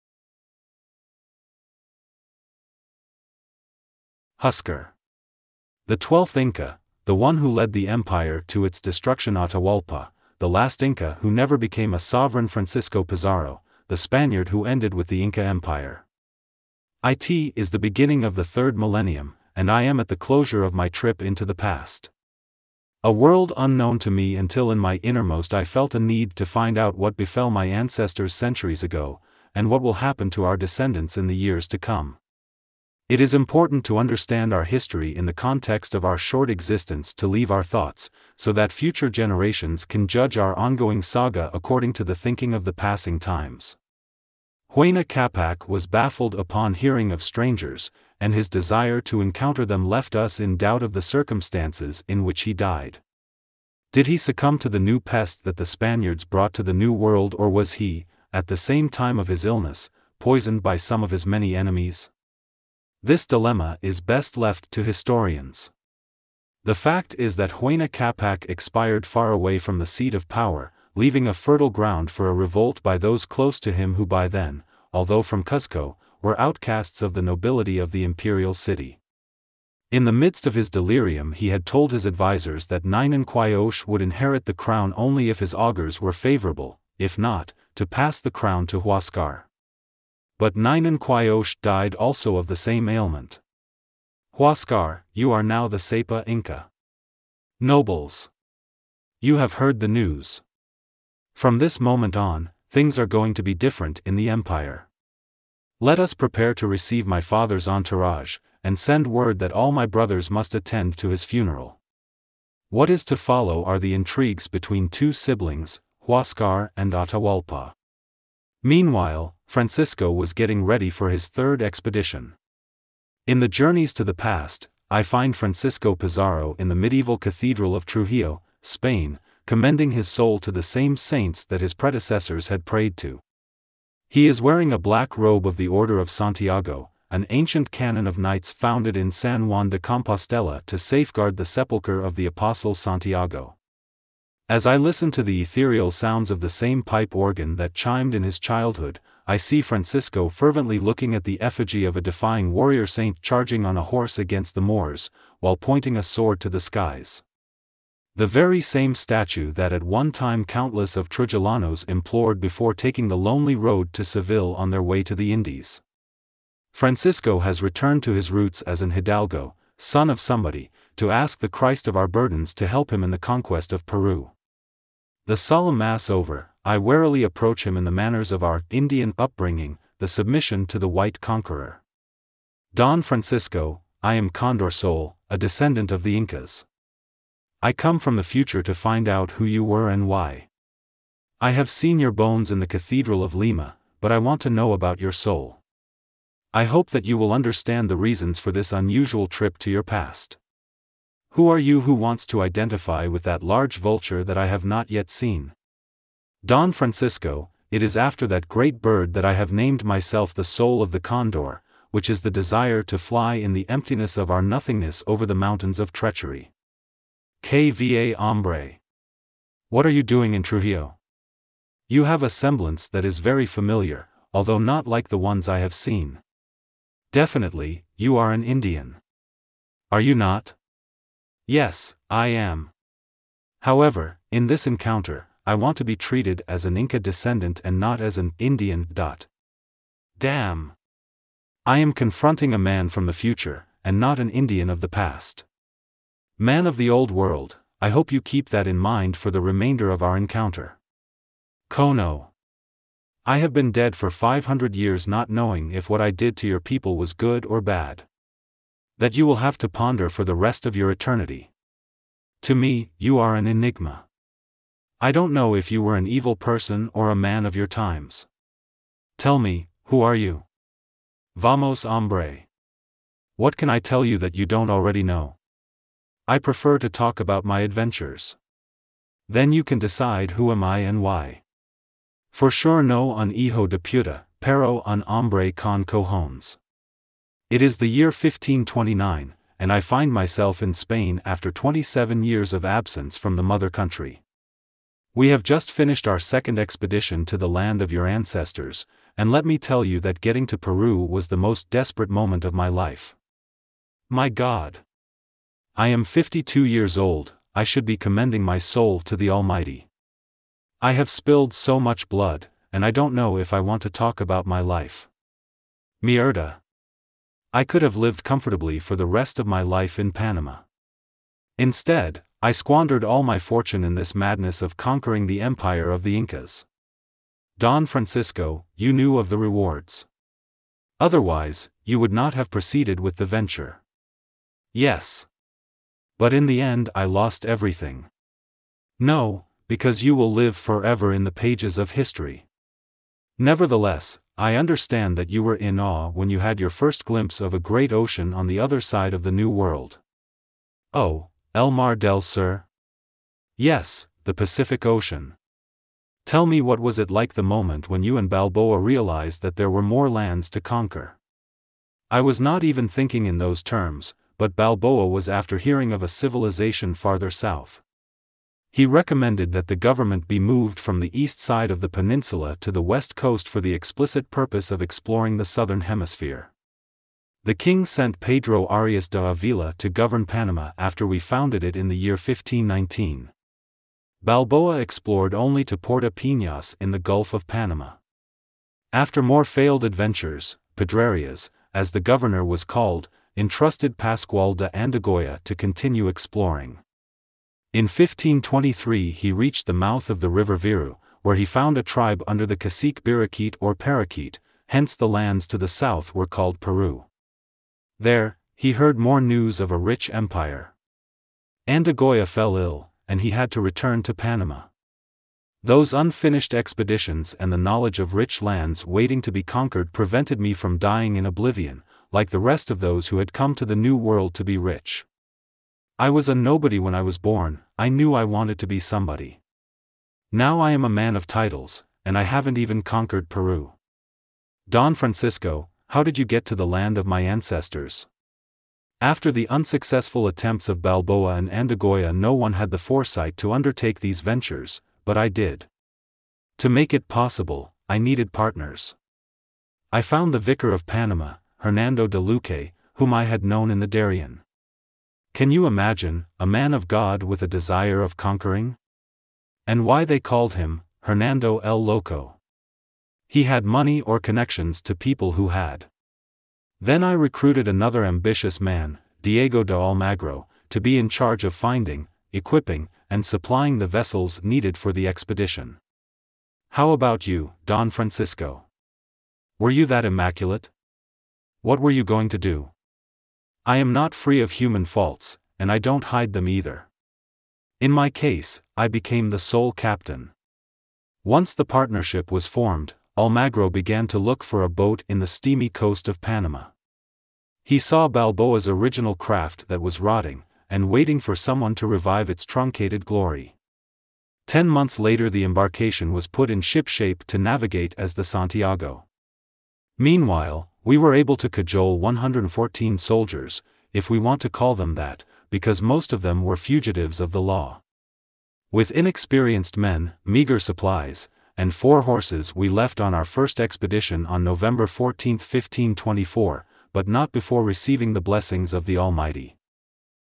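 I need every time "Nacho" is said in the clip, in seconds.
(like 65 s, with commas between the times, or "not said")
not said.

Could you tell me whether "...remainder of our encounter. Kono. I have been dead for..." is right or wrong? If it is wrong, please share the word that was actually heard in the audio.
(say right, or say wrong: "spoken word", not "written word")
right.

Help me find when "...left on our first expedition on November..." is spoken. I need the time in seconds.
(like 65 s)
522 s.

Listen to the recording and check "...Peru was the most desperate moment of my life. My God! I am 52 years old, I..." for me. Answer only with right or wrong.
right.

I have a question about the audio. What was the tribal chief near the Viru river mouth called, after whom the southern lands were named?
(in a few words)
Birakeet.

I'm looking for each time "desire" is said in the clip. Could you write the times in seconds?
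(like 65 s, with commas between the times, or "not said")
48 s, 212 s, 457 s.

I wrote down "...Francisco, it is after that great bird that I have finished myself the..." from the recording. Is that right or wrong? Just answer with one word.
wrong.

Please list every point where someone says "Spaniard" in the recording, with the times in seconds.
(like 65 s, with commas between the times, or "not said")
13 s, 55 s.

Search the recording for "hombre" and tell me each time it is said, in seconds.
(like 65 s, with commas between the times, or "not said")
218 s, 271 s, 285 s.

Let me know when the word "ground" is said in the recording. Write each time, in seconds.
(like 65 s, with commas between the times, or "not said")
71 s.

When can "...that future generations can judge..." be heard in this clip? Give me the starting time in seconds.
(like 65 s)
38 s.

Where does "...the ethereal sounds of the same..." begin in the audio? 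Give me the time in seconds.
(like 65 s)
145 s.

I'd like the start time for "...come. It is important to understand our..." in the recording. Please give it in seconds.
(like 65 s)
31 s.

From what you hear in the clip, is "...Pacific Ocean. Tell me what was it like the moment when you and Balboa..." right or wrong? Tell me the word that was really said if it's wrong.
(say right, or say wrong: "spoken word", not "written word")
right.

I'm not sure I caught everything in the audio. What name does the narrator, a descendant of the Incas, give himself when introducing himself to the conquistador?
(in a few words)
Condor Soul.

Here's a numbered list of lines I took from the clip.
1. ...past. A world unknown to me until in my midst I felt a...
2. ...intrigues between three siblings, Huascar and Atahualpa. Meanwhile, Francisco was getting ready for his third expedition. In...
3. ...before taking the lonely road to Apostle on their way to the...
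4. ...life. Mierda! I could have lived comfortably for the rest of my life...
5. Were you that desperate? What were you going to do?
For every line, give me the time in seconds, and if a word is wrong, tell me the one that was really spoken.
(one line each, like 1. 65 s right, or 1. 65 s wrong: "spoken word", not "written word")
1. 21 s wrong: "innermost", not "midst"
2. 113 s wrong: "two", not "three"
3. 162 s wrong: "Seville", not "Apostle"
4. 314 s right
5. 479 s wrong: "immaculate", not "desperate".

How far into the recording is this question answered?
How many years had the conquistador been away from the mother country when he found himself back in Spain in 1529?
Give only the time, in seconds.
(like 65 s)
291 s.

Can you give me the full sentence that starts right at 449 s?
I found the vicar of Panama, Hernando de Luque, whom I had known in the Darien.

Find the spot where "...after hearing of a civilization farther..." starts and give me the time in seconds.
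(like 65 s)
365 s.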